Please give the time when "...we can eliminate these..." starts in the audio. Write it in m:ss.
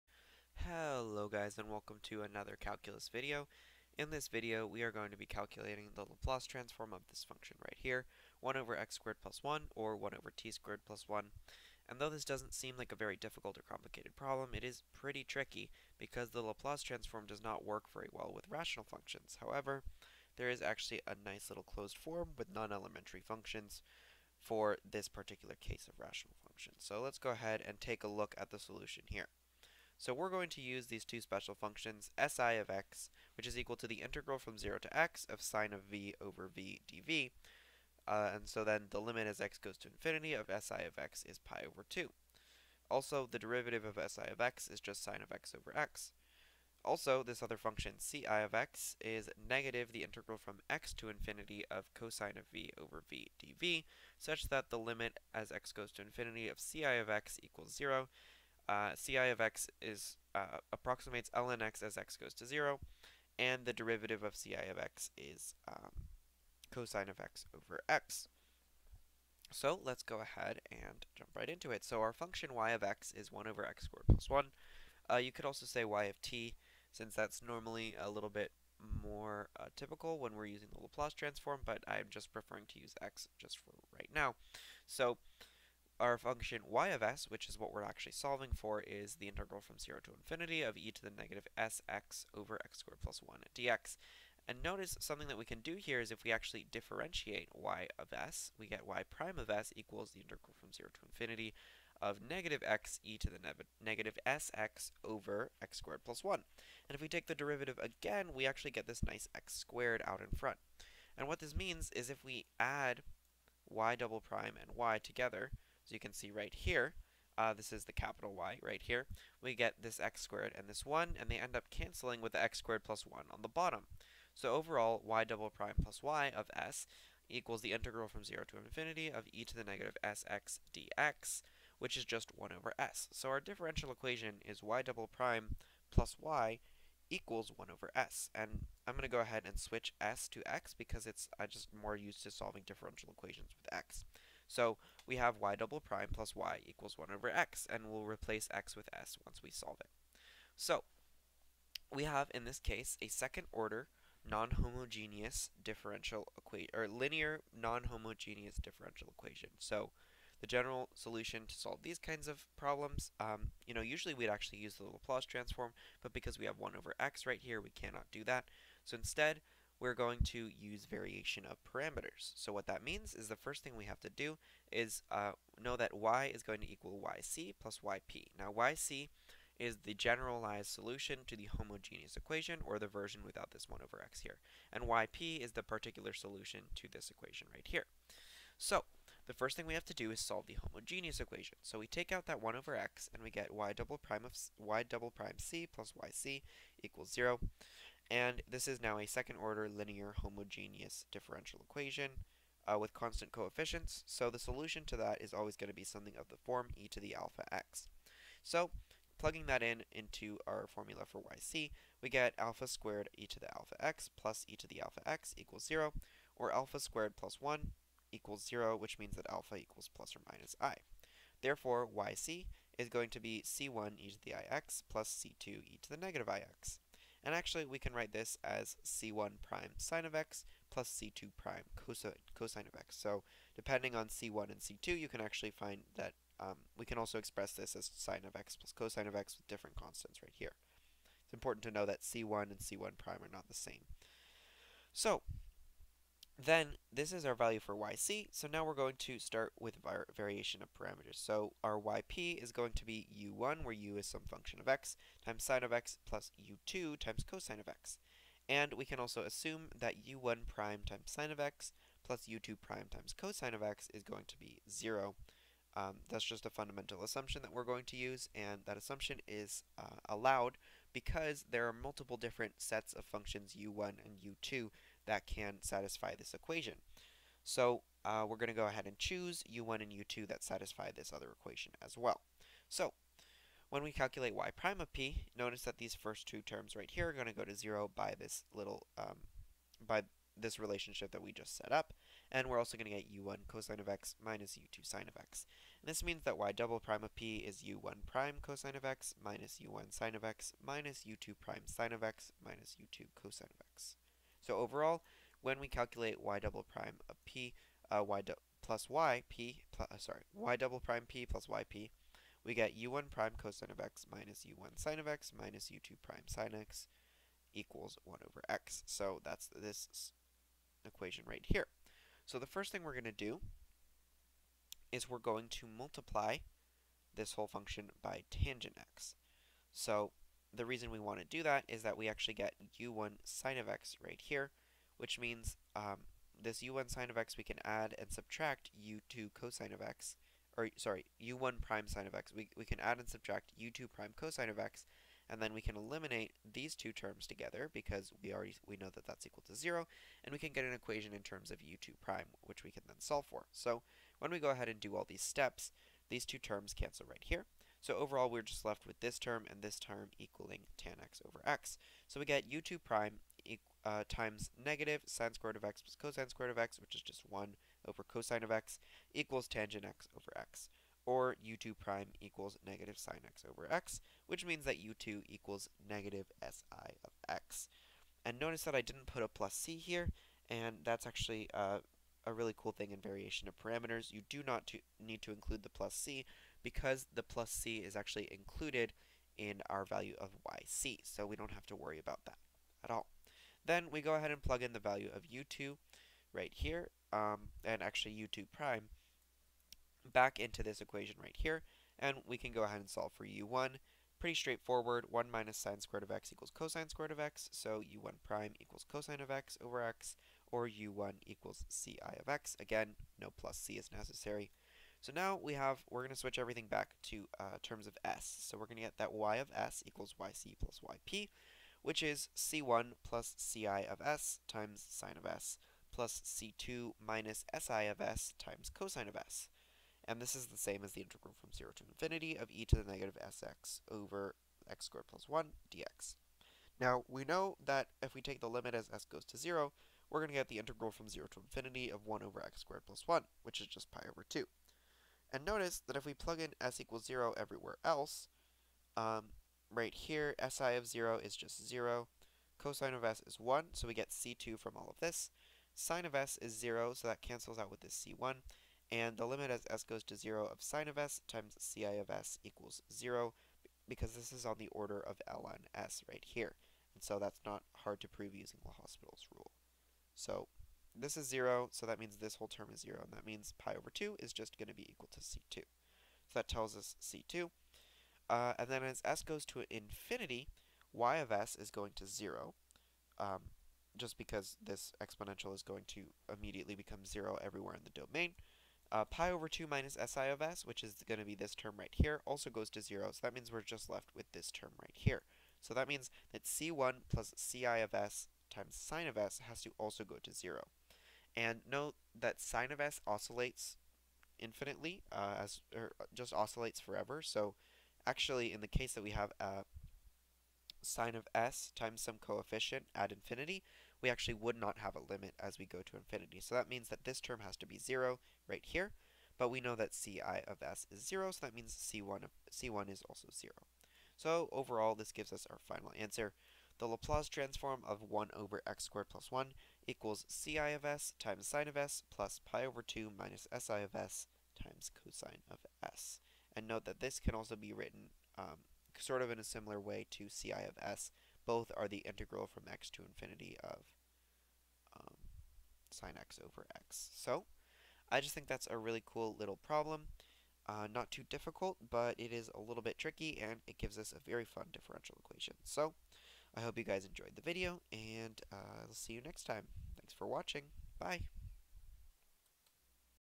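5:45.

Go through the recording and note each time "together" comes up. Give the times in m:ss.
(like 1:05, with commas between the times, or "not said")
1:54, 5:47.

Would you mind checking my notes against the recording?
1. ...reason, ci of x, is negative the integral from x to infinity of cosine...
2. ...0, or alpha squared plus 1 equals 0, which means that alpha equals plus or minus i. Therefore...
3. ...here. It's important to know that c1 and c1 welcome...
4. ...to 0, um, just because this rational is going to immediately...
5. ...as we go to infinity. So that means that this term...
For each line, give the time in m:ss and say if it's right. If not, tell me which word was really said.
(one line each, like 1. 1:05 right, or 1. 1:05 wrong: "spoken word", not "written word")
1. 0:47 wrong: "function", not "reason"
2. 3:35 right
3. 4:00 wrong: "prime", not "welcome"
4. 8:01 wrong: "exponential", not "rational"
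5. 8:35 right.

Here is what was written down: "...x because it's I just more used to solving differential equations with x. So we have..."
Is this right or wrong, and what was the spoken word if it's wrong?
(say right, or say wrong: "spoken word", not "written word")
right.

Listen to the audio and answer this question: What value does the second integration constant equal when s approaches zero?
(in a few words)
pi/2.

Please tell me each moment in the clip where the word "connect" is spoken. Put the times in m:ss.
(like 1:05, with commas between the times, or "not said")
not said.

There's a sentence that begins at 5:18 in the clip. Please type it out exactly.
So that's this equation right here.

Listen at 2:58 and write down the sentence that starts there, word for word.
Now yc is the generalized solution to the homogeneous equation, or the version without this 1 over x here.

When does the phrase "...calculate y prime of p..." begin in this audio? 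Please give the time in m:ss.
4:43.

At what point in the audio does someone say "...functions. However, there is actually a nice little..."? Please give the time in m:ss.
0:18.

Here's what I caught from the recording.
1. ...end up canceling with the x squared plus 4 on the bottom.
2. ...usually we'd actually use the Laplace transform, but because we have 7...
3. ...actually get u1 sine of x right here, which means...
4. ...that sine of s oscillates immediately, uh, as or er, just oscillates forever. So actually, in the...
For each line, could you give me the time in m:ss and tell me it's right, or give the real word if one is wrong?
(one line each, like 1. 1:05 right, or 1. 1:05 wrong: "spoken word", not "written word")
1. 2:01 wrong: "1", not "4"
2. 2:43 wrong: "1", not "7"
3. 5:32 right
4. 8:22 wrong: "infinitely", not "immediately".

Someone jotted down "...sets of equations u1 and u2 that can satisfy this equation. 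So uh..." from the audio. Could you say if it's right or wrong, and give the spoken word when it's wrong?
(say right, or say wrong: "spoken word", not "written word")
wrong: "functions", not "equations".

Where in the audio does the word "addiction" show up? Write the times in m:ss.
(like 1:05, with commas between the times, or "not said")
not said.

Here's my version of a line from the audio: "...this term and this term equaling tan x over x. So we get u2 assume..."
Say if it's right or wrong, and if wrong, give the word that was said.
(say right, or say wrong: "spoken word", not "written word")
wrong: "prime", not "assume".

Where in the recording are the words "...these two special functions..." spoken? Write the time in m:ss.
0:30.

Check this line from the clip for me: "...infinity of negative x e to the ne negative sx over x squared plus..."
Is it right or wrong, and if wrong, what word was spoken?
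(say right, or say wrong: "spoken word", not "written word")
right.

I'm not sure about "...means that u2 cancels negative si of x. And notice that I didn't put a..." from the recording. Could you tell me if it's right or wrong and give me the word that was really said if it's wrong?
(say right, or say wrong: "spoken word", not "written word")
wrong: "equals", not "cancels".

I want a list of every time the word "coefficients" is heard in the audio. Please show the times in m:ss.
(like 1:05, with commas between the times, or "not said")
3:23, 8:32.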